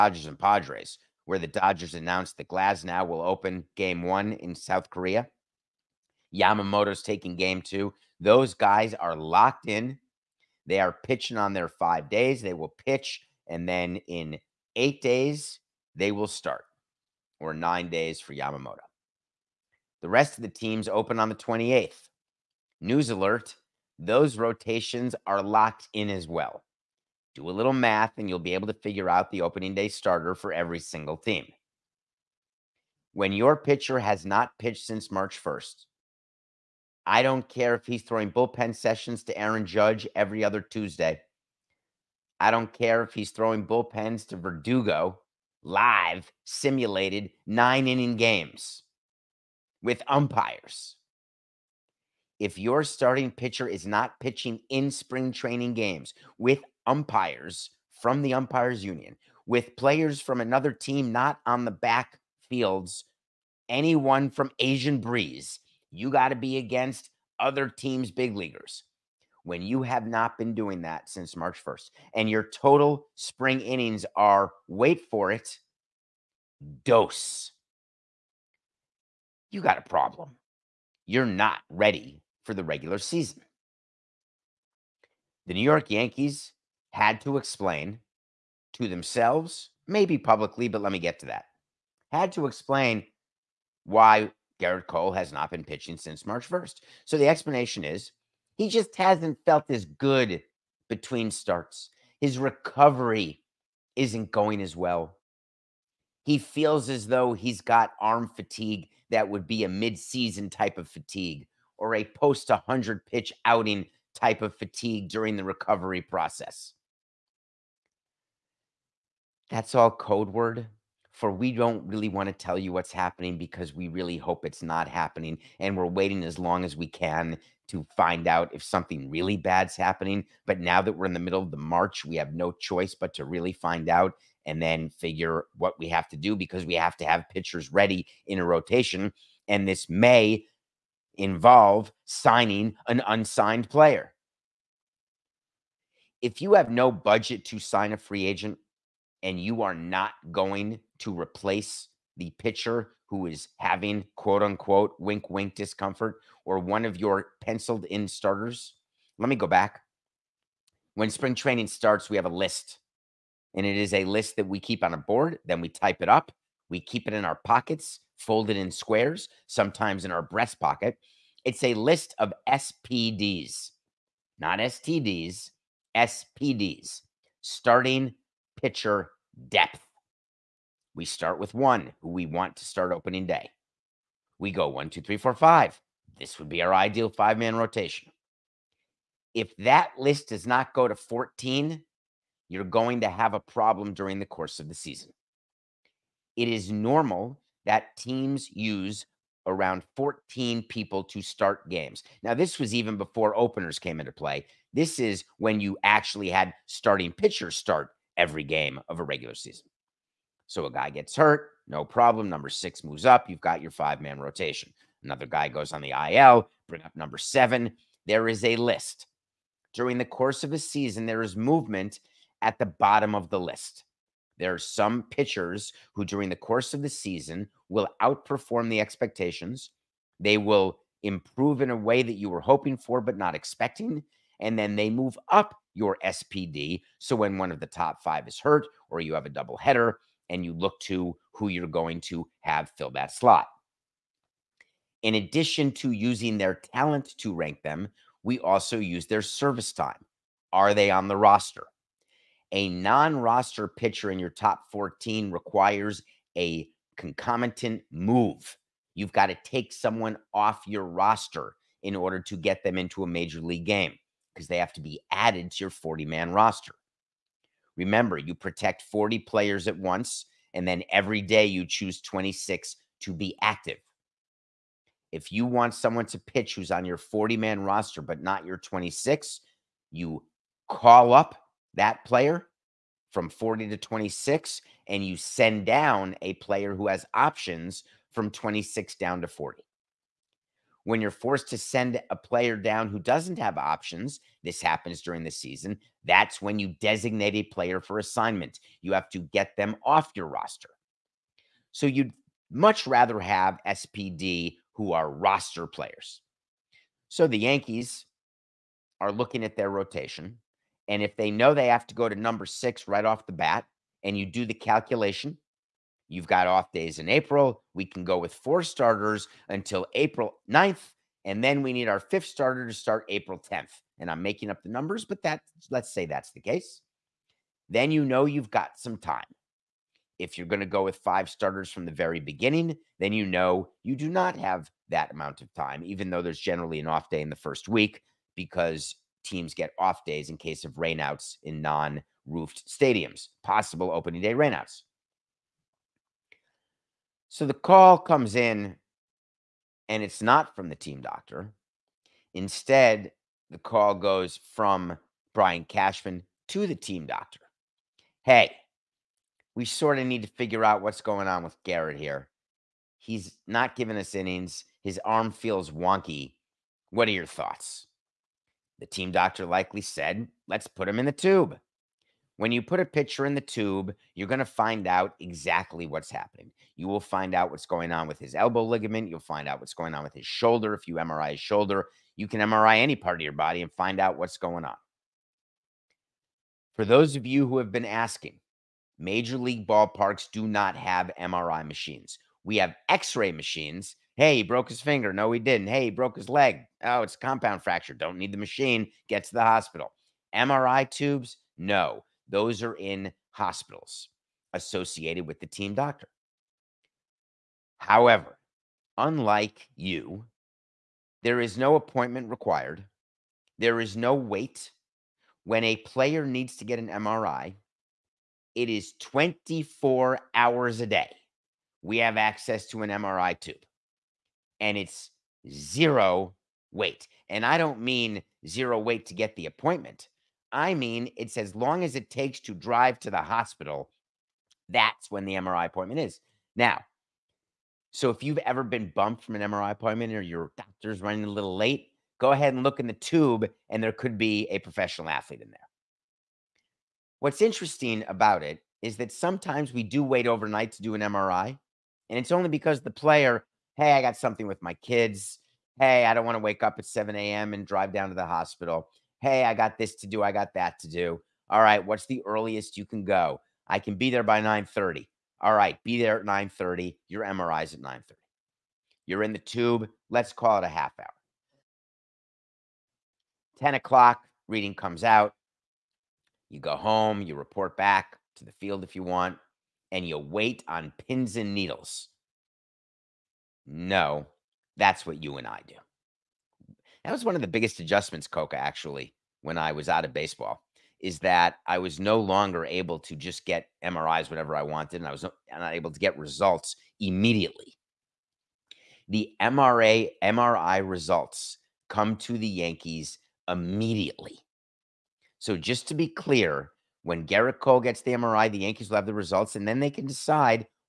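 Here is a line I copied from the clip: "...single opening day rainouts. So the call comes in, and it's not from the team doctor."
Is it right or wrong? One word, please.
wrong.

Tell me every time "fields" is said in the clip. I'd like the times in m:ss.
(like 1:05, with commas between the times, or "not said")
1:02, 7:58.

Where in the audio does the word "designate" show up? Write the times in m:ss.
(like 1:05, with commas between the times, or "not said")
4:56.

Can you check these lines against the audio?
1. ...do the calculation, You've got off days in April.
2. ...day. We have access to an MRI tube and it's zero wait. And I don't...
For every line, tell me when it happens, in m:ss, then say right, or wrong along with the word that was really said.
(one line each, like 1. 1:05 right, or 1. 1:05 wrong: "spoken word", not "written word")
1. 5:14 right
2. 7:00 right.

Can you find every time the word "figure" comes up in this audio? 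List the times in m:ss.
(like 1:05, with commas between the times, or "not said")
0:28, 2:14, 6:00.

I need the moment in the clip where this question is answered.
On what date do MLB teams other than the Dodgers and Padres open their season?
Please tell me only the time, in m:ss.
0:21.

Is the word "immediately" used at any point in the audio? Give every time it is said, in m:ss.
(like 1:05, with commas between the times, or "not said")
8:17, 8:23.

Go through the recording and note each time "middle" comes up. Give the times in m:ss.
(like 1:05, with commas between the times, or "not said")
2:11.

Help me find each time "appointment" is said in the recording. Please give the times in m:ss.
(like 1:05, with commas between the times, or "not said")
6:51, 7:09, 7:15, 7:19.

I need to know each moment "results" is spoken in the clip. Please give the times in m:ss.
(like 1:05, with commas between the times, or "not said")
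8:16, 8:20, 8:29.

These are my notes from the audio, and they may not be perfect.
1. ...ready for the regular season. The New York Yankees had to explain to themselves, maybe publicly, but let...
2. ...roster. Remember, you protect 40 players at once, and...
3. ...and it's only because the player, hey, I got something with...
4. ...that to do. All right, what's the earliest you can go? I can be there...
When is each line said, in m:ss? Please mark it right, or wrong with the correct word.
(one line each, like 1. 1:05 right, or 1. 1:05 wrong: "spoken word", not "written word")
1. 1:21 right
2. 4:26 right
3. 7:32 right
4. 7:40 right.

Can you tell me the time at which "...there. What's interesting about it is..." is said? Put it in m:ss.
7:25.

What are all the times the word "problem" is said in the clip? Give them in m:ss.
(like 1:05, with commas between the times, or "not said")
1:19, 3:13, 3:31.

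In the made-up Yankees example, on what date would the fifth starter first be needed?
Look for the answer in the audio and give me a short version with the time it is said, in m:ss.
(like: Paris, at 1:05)
April 10, at 5:23.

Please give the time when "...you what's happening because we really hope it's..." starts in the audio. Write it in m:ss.
2:02.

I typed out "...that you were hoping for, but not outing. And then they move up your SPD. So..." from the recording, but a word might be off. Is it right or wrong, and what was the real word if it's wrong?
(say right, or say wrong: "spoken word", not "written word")
wrong: "expecting", not "outing".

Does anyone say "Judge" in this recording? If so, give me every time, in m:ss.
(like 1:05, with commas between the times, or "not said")
0:39.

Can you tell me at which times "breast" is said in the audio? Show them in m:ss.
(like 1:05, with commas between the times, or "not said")
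2:50.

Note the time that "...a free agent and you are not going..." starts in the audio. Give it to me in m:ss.
2:27.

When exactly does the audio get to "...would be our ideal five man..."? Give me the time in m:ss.
3:06.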